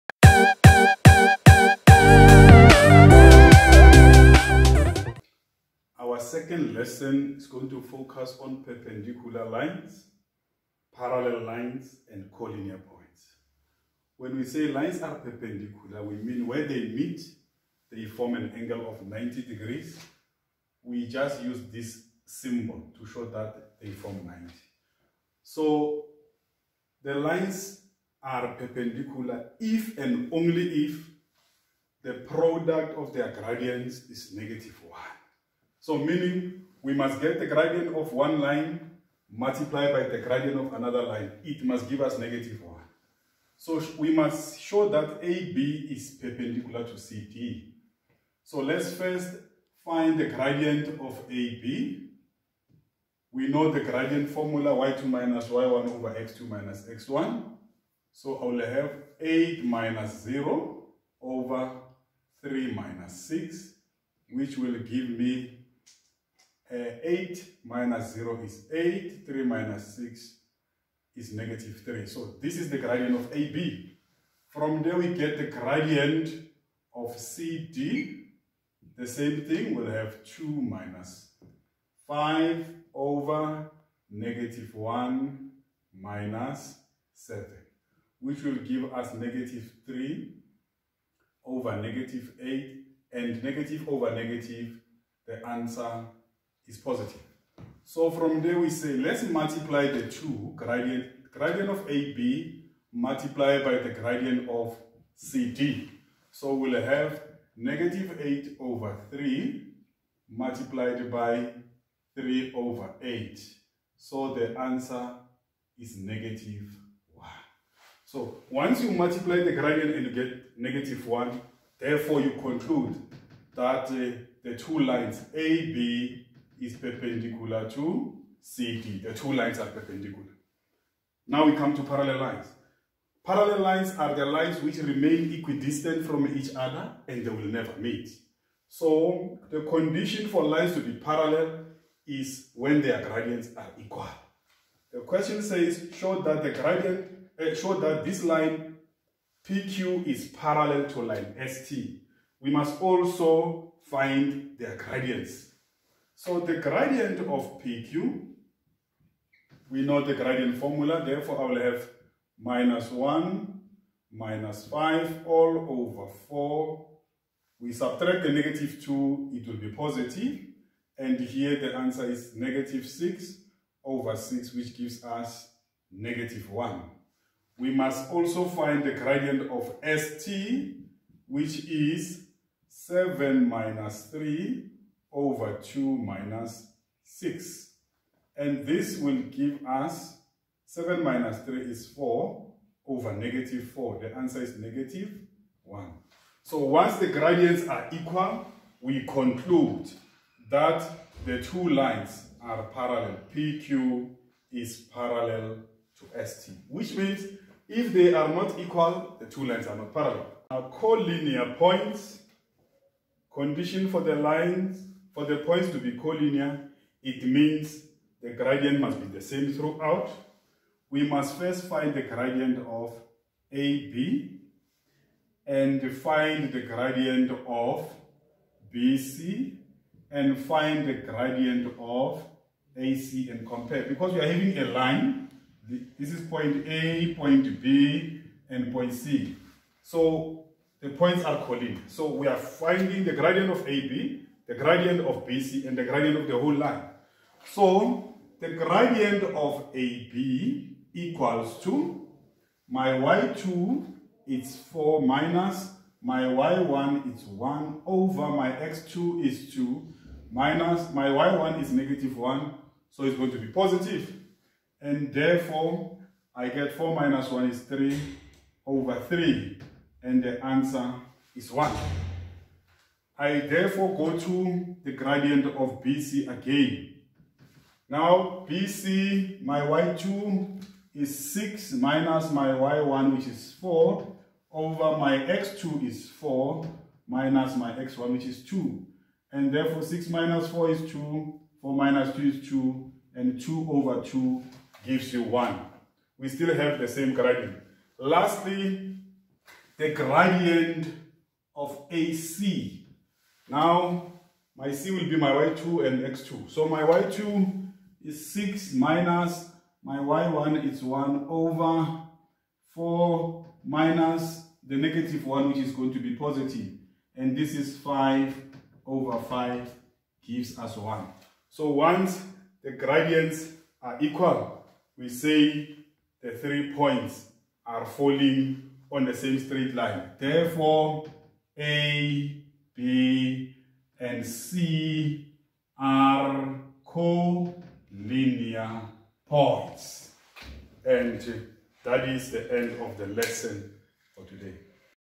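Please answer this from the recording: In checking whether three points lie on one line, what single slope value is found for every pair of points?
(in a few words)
1.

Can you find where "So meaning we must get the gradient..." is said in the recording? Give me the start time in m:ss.
0:35.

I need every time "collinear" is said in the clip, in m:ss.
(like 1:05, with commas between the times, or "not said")
0:12, 3:30, 3:35, 4:01, 5:36.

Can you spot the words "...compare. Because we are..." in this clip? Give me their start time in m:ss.
3:53.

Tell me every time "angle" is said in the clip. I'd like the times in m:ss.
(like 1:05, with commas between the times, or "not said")
0:18.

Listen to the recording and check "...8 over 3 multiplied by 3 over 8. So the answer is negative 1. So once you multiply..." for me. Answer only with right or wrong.
right.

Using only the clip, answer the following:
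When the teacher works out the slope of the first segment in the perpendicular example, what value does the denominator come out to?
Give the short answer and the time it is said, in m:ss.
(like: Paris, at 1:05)
-3, at 1:09.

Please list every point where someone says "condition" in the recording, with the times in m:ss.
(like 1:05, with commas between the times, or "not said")
2:19, 3:33.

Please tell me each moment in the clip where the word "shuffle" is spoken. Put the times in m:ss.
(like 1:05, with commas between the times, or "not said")
not said.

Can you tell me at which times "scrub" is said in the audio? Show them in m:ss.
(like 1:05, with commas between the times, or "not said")
not said.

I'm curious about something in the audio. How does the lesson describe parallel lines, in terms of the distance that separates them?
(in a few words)
Equidistant.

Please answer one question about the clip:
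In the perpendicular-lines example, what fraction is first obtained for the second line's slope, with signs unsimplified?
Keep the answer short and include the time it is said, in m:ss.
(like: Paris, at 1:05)
-3/-8, at 1:29.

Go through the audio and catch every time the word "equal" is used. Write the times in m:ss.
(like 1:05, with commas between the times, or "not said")
2:23, 3:17, 3:28, 4:10, 5:23.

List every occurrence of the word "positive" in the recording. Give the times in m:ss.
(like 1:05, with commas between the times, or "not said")
1:36, 2:49, 4:23, 5:16.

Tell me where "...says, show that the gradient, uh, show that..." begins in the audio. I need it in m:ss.
2:25.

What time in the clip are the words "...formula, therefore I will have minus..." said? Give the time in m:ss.
2:40.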